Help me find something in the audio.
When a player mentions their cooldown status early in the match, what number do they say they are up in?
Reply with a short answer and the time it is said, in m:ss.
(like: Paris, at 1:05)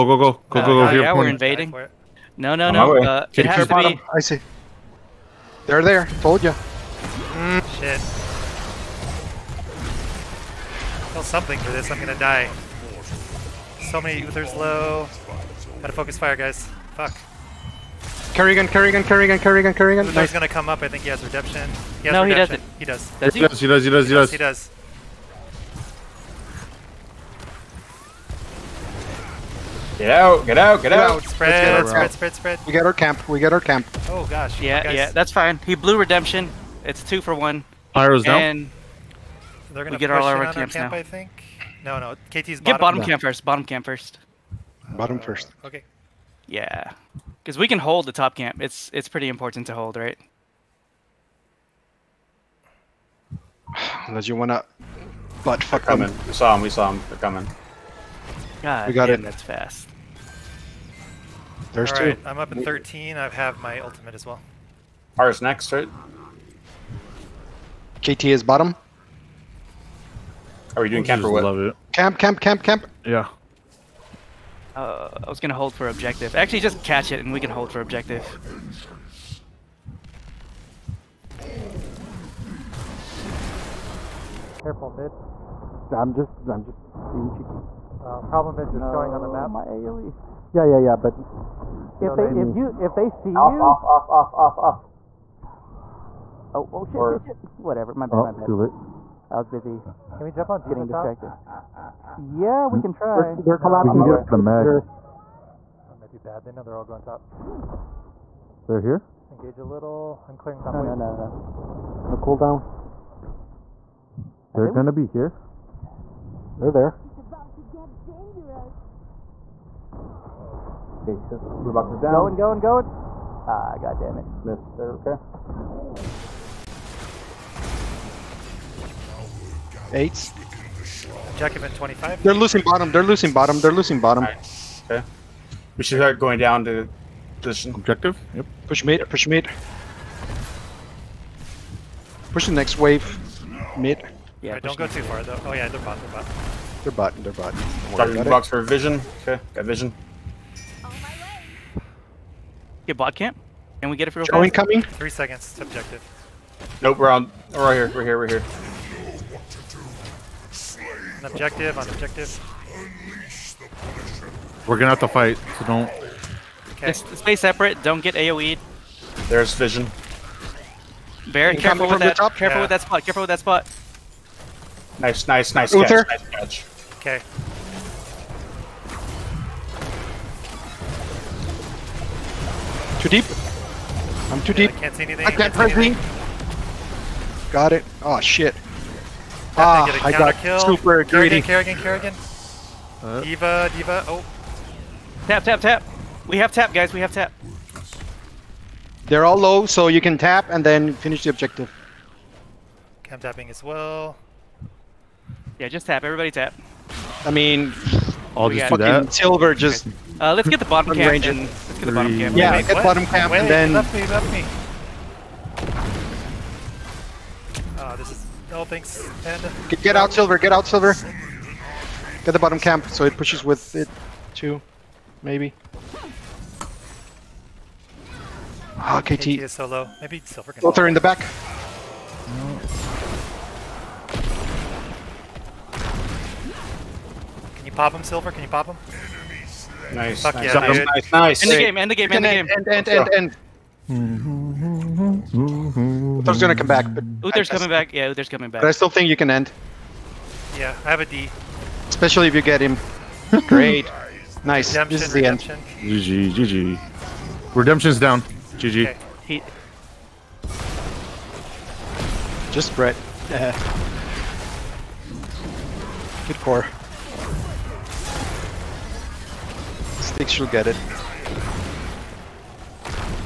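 13, at 1:02.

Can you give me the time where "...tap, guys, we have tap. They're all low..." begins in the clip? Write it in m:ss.
3:16.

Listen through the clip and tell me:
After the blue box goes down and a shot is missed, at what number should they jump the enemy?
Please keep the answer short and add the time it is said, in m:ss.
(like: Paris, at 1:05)
25, at 2:11.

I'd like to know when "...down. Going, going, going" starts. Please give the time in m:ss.
2:01.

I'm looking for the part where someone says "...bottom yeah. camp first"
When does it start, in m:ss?
0:42.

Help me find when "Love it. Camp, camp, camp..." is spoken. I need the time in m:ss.
1:11.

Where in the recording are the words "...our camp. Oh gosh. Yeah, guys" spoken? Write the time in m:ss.
0:33.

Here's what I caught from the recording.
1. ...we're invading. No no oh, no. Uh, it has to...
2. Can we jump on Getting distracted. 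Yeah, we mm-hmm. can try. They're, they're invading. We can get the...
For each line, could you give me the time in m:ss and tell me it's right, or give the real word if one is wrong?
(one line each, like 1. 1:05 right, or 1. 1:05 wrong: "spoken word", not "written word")
1. 0:01 right
2. 1:40 wrong: "collapsing", not "invading".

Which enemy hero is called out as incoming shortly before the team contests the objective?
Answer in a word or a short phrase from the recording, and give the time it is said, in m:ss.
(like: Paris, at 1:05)
Joe, at 2:34.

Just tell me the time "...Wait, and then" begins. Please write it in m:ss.
3:33.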